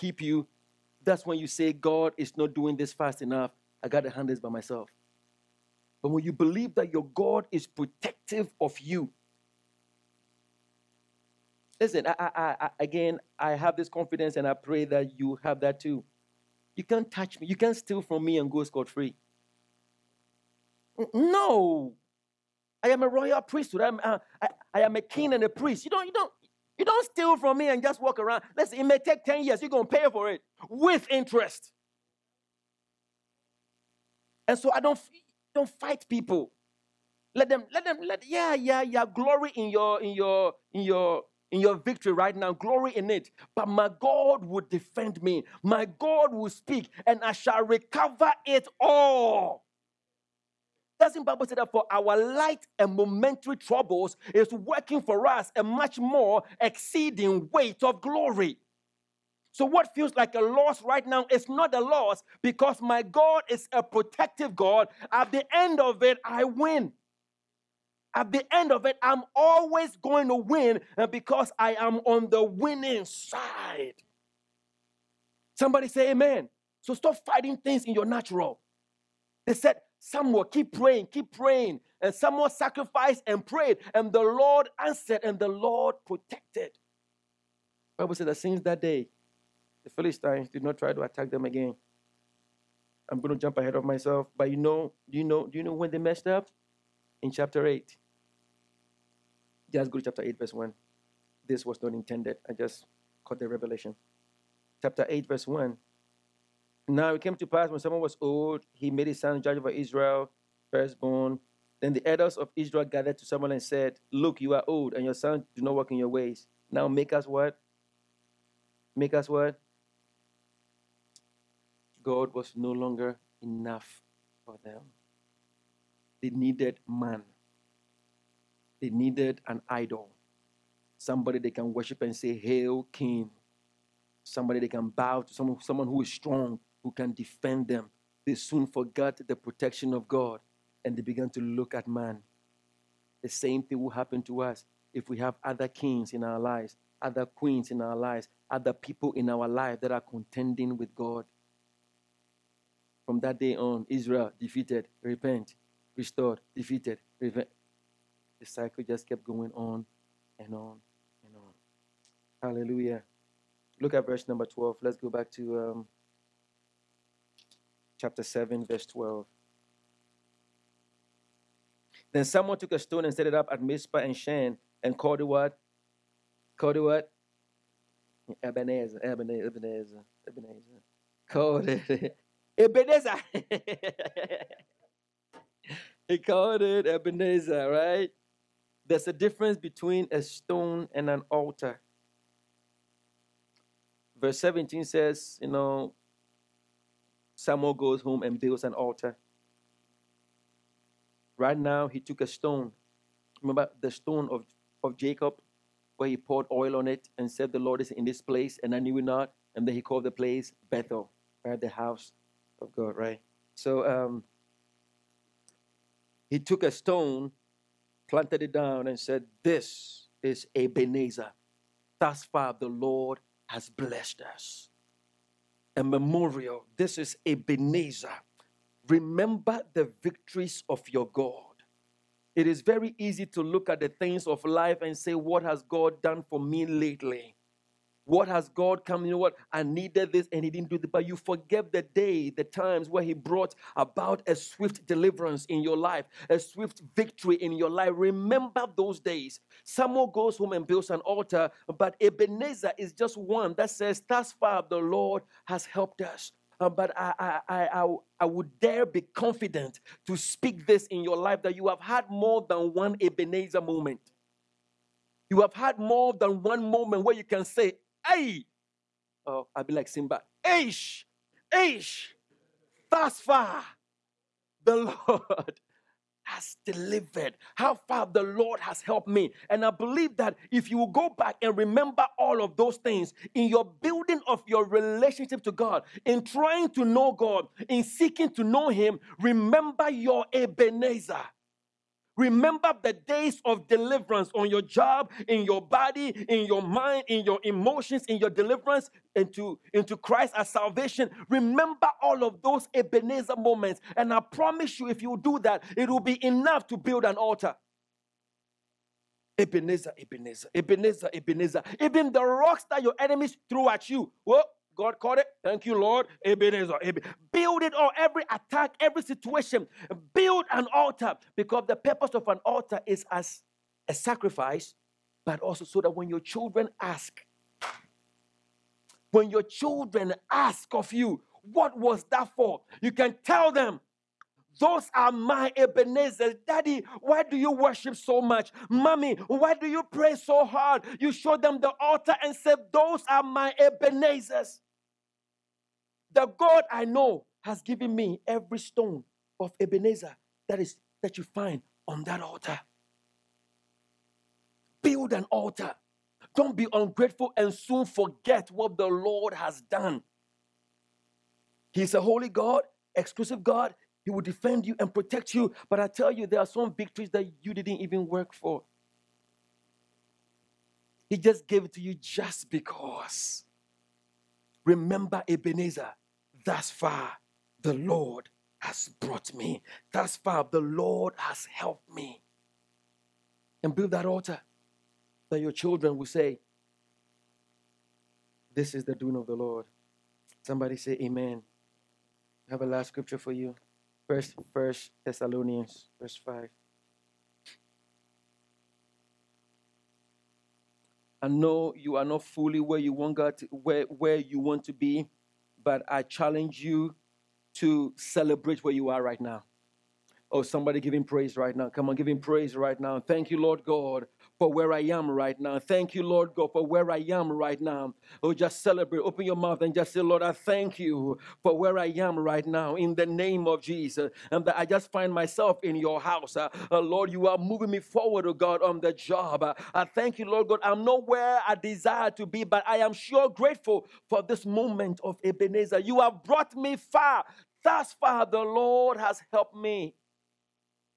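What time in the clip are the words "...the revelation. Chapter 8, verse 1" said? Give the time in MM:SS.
01:43.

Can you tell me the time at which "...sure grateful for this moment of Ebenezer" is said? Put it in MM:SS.
07:12.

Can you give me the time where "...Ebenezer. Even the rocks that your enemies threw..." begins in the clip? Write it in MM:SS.
05:11.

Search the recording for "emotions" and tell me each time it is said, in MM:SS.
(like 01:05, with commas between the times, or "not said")
04:57.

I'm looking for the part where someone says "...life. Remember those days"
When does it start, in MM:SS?
04:07.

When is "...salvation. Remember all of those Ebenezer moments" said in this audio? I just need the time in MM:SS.
05:00.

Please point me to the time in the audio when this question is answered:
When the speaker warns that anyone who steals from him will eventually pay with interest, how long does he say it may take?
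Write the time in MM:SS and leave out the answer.
00:29.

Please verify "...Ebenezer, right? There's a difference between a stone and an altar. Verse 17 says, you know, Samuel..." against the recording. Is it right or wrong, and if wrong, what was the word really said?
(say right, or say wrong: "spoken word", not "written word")
right.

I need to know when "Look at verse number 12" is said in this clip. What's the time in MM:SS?
02:43.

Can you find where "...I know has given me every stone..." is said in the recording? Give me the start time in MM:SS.
05:46.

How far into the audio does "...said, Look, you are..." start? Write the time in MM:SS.
01:53.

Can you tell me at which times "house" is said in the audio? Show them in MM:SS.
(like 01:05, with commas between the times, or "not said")
03:31, 07:05.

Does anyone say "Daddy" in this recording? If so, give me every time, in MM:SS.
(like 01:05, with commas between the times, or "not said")
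05:36.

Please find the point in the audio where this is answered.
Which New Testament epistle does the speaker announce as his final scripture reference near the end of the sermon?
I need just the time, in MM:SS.
06:34.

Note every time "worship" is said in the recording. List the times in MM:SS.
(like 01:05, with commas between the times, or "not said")
02:11, 05:37.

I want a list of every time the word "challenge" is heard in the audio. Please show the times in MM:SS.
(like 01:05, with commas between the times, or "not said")
06:46.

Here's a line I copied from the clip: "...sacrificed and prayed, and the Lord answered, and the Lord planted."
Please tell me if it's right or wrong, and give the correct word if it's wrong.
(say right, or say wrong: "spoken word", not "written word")
wrong: "protected", not "planted".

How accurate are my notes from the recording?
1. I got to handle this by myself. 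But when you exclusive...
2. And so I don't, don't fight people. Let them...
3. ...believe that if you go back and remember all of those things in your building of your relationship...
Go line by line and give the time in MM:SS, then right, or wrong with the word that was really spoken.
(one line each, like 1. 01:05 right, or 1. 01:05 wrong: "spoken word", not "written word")
1. 00:03 wrong: "believe", not "exclusive"
2. 00:34 right
3. 04:39 right.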